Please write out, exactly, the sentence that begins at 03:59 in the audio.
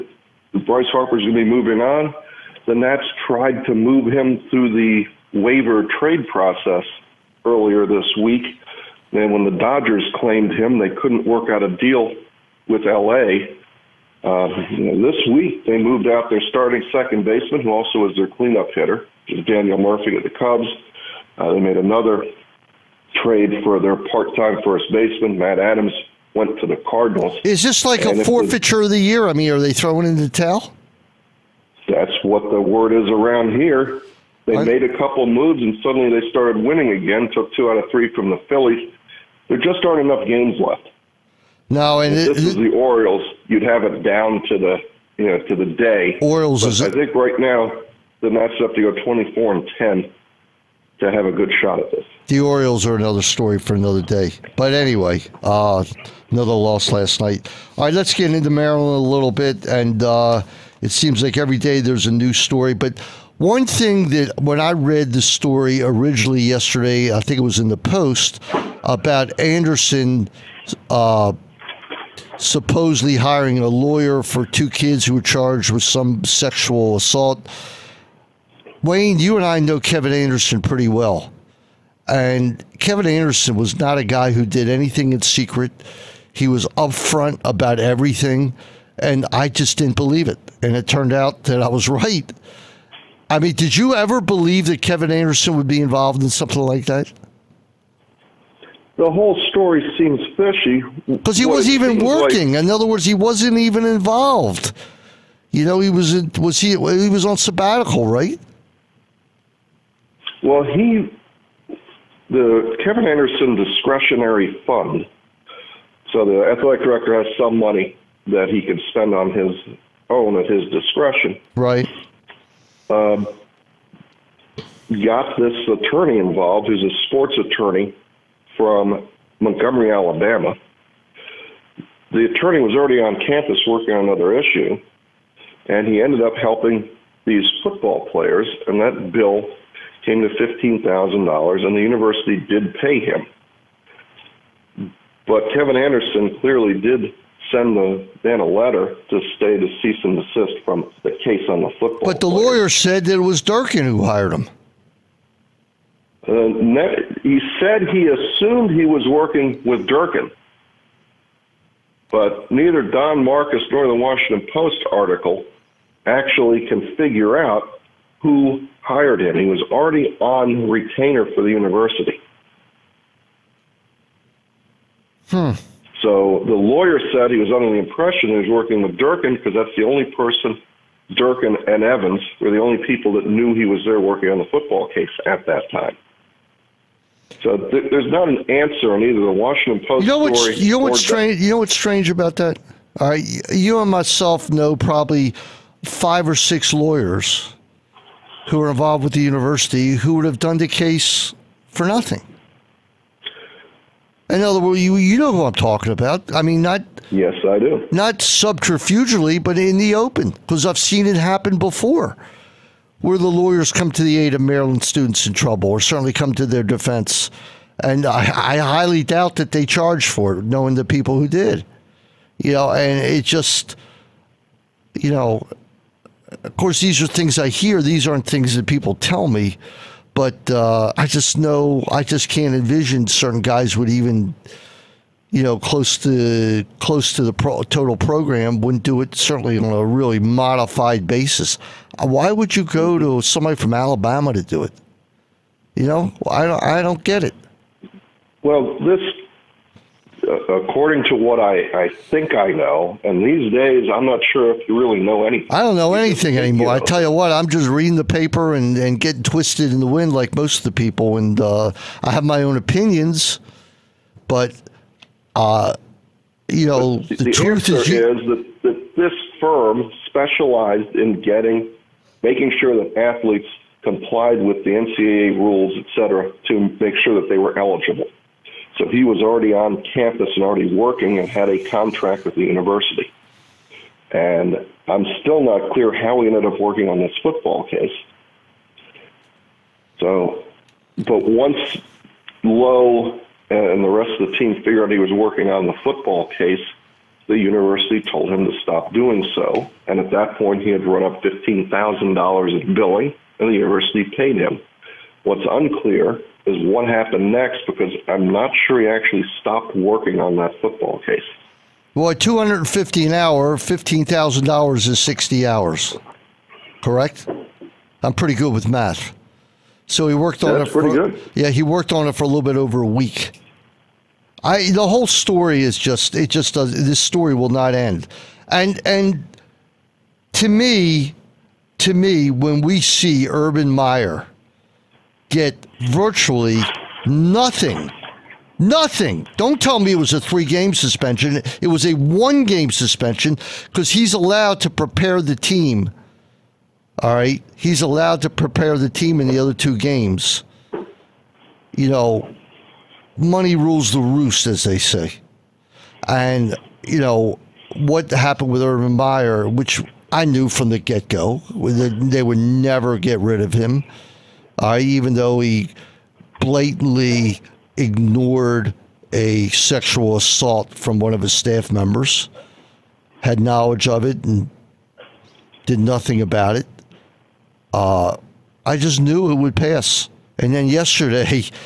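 Certainly on a really modified basis.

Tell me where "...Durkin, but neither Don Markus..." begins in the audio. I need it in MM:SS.
02:39.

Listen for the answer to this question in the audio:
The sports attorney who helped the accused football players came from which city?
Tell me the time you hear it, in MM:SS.
02:09.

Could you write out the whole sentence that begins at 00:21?
Uh, they made another trade for their part-time first baseman, Matt Adams, went to the Cardinals.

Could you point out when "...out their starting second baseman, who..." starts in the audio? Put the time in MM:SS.
00:16.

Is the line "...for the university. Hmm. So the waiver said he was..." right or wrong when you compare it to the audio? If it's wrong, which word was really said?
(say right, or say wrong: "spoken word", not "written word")
wrong: "lawyer", not "waiver".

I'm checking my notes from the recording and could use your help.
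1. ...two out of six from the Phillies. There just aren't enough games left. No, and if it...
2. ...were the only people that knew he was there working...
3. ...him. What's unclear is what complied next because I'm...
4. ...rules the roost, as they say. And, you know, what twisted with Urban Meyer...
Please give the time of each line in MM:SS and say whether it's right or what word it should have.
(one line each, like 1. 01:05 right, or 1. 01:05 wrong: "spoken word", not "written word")
1. 00:37 wrong: "three", not "six"
2. 03:02 right
3. 05:04 wrong: "happened", not "complied"
4. 05:53 wrong: "happened", not "twisted".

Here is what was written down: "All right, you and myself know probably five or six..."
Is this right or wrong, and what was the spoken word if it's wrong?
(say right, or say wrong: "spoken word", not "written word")
right.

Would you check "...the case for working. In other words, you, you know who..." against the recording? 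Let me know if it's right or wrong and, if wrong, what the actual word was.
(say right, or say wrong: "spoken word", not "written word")
wrong: "nothing", not "working".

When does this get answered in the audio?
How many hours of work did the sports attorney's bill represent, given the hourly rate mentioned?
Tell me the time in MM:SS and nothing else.
05:14.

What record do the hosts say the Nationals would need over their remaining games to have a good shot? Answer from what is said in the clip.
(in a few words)
24 and 10.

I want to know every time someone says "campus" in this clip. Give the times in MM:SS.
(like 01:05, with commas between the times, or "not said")
02:13, 04:39.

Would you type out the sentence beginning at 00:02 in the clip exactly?
The Nats tried to move him through the waiver trade process earlier this week.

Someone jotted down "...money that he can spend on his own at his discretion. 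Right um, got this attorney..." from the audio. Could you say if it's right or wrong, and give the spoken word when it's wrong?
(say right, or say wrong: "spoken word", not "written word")
right.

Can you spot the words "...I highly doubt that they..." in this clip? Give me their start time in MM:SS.
03:38.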